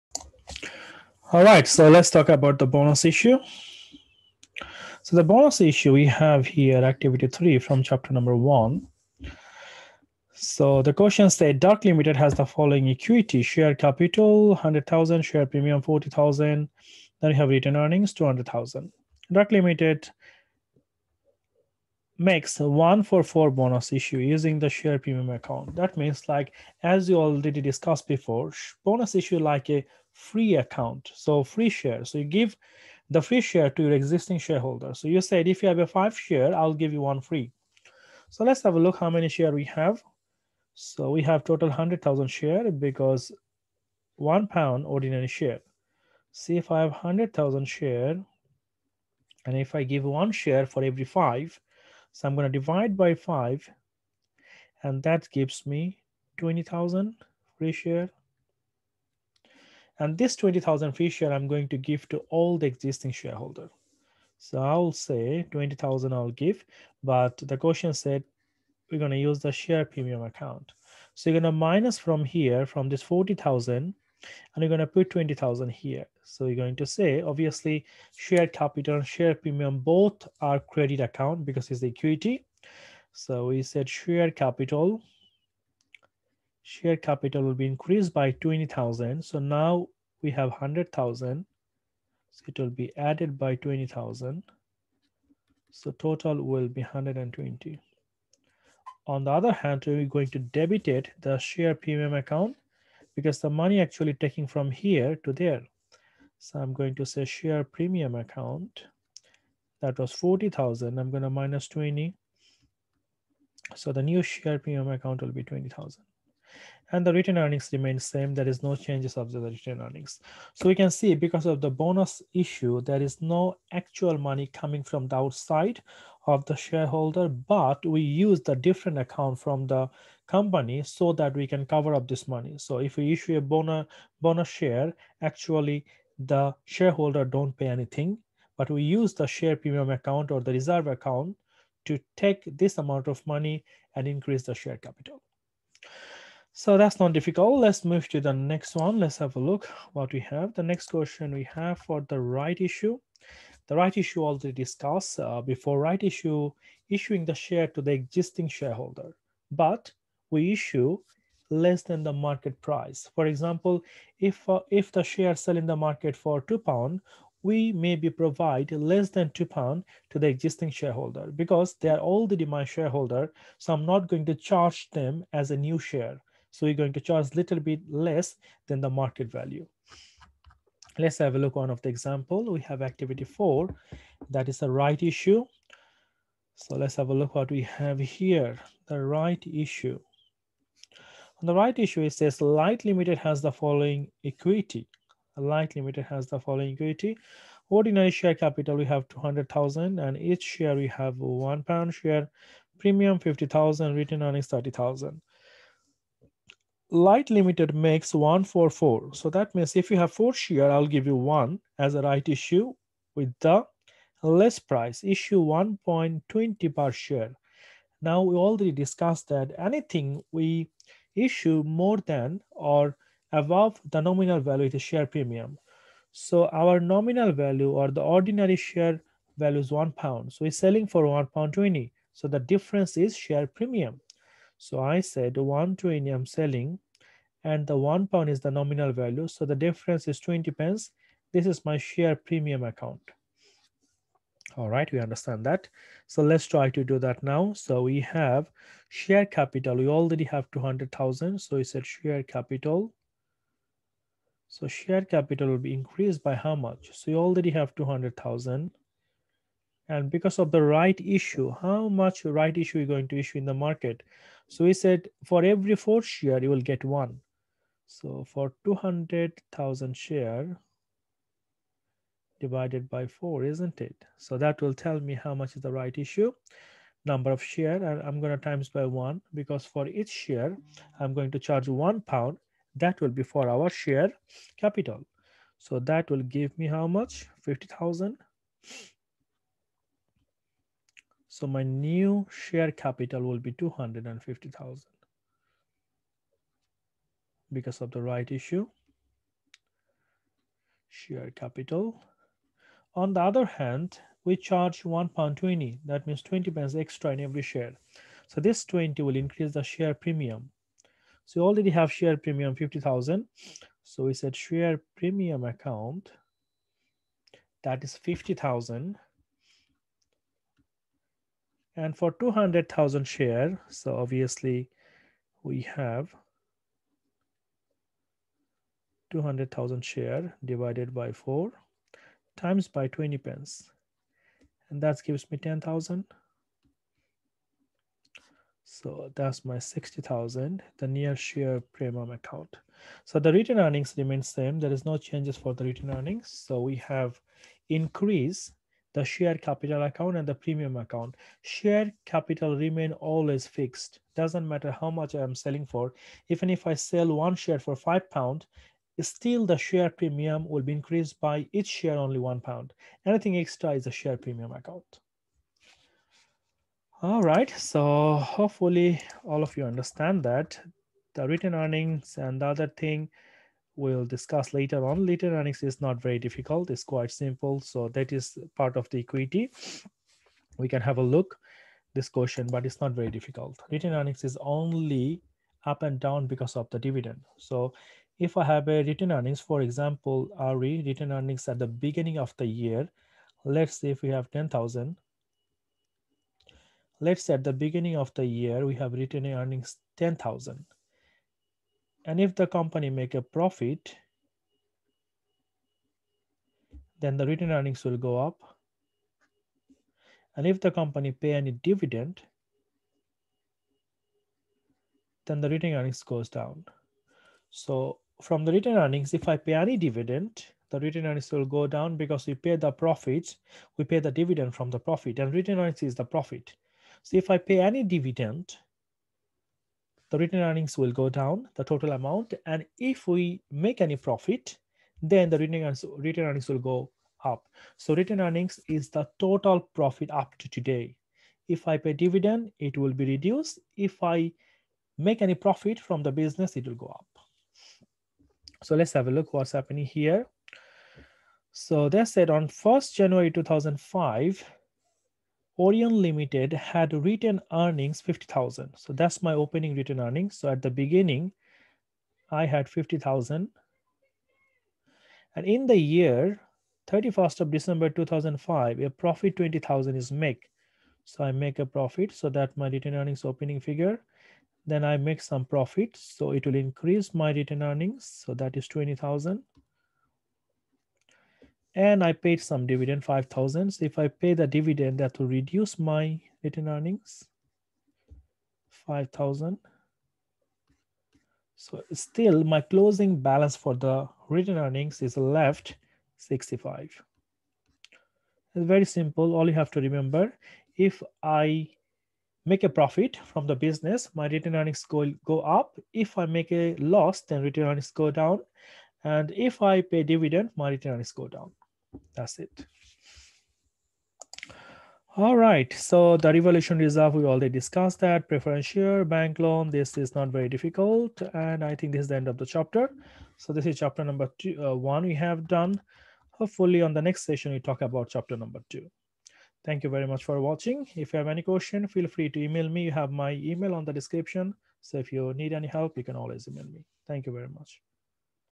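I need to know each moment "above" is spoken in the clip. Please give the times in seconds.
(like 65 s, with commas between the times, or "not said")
223 s.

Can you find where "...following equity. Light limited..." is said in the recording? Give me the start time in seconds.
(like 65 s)
193 s.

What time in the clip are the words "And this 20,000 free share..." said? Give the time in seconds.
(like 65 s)
59 s.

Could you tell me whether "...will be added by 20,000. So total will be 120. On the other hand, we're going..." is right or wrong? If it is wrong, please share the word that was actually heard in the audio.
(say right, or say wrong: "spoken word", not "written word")
right.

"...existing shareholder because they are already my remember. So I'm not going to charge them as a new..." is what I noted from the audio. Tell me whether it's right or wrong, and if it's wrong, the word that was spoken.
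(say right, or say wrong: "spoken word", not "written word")
wrong: "shareholder", not "remember".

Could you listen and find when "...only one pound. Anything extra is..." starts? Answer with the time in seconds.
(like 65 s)
361 s.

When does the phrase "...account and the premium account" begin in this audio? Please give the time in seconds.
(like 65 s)
349 s.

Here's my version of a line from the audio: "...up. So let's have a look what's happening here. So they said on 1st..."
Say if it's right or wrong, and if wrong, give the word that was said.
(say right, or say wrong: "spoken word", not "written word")
right.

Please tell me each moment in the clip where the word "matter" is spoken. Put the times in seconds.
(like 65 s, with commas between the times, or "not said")
354 s.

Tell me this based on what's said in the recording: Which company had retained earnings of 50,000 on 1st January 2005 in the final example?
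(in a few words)
Orion Limited.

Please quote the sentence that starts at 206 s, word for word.
Light limited makes one for four.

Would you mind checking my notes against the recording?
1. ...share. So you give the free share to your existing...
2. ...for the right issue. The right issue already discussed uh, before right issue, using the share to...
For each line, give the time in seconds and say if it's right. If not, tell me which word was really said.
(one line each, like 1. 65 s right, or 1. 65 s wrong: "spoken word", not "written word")
1. 31 s right
2. 151 s wrong: "issuing", not "using".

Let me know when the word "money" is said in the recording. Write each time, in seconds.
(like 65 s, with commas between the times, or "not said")
103 s, 124 s, 132 s, 143 s.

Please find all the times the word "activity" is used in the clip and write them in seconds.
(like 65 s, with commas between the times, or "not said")
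6 s, 182 s.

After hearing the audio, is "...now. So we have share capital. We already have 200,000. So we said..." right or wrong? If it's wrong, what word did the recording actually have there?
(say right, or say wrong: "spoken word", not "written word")
right.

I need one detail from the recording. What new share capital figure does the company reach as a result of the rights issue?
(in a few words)
250,000.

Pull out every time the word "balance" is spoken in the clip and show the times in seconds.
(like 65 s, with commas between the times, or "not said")
493 s.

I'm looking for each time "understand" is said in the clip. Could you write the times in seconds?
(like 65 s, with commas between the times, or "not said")
244 s, 369 s.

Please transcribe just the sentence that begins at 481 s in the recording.
And I paid some dividend, 5,000.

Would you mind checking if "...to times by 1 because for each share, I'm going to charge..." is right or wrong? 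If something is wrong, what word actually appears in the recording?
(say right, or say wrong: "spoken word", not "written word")
right.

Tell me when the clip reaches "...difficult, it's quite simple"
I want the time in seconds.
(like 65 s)
376 s.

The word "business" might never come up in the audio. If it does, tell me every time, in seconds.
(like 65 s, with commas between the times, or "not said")
446 s, 503 s.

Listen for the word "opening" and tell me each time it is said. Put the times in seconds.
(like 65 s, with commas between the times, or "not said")
459 s, 473 s.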